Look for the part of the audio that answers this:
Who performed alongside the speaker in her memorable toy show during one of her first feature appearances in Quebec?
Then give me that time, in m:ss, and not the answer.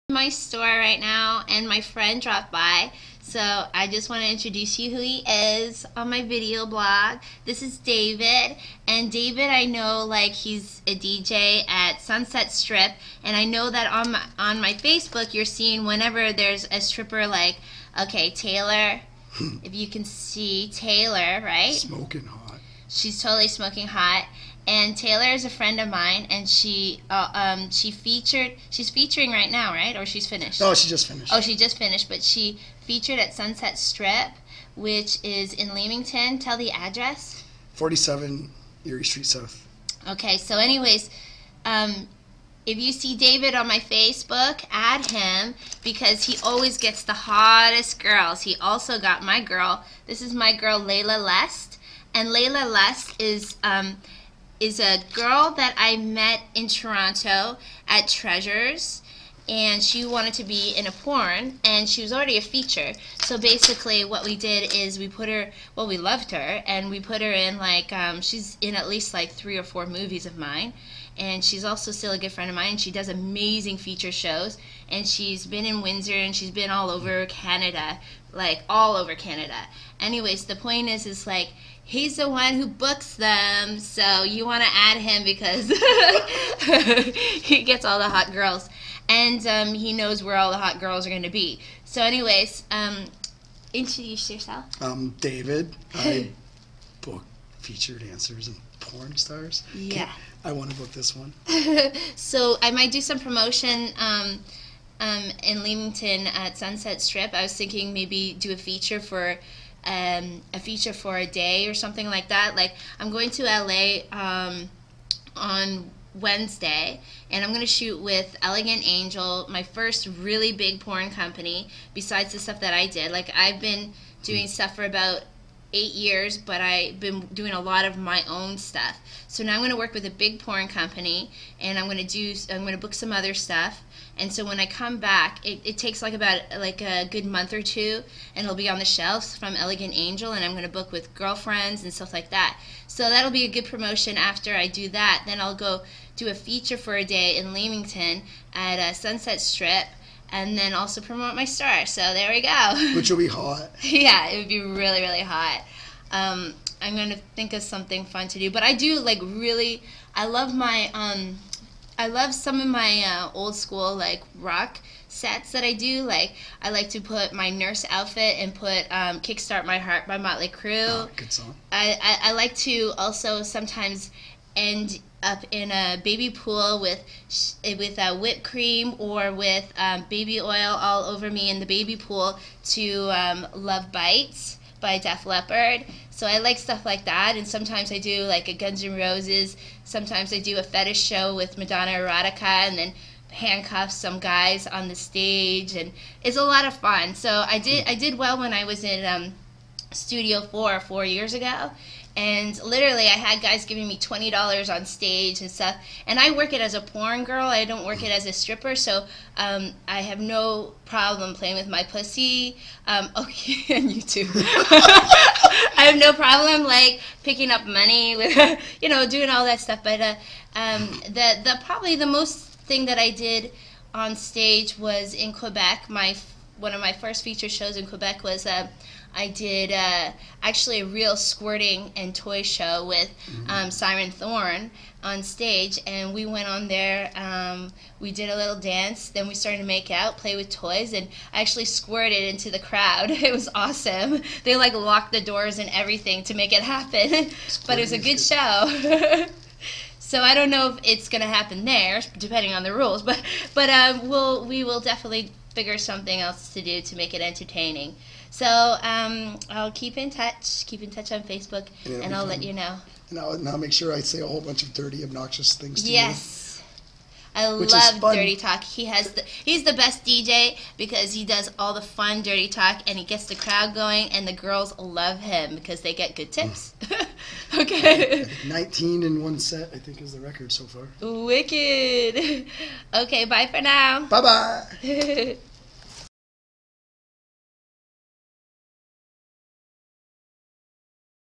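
3:53.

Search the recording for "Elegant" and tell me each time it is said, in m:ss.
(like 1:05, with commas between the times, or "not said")
1:58, 2:19.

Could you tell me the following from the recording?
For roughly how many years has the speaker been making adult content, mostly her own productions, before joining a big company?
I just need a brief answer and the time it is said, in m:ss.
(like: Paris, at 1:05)
8 years, at 2:05.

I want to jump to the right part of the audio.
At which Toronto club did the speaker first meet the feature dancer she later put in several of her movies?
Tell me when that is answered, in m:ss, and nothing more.
0:58.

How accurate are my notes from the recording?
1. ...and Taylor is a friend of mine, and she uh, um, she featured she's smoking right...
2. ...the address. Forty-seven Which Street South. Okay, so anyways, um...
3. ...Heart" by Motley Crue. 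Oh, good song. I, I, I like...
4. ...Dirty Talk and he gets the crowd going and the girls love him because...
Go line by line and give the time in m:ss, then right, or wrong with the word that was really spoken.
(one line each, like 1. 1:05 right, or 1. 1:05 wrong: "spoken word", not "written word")
1. 0:24 wrong: "featuring", not "smoking"
2. 0:36 wrong: "Erie", not "Which"
3. 2:49 right
4. 4:32 right.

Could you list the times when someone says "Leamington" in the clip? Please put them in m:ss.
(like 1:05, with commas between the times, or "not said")
0:35, 1:45, 2:27.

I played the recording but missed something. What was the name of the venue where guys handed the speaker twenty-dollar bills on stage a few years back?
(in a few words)
Studio 4.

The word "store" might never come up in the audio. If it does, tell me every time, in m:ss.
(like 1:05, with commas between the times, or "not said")
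0:00, 2:31.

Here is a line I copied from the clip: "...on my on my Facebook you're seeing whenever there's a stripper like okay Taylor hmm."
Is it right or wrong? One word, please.
right.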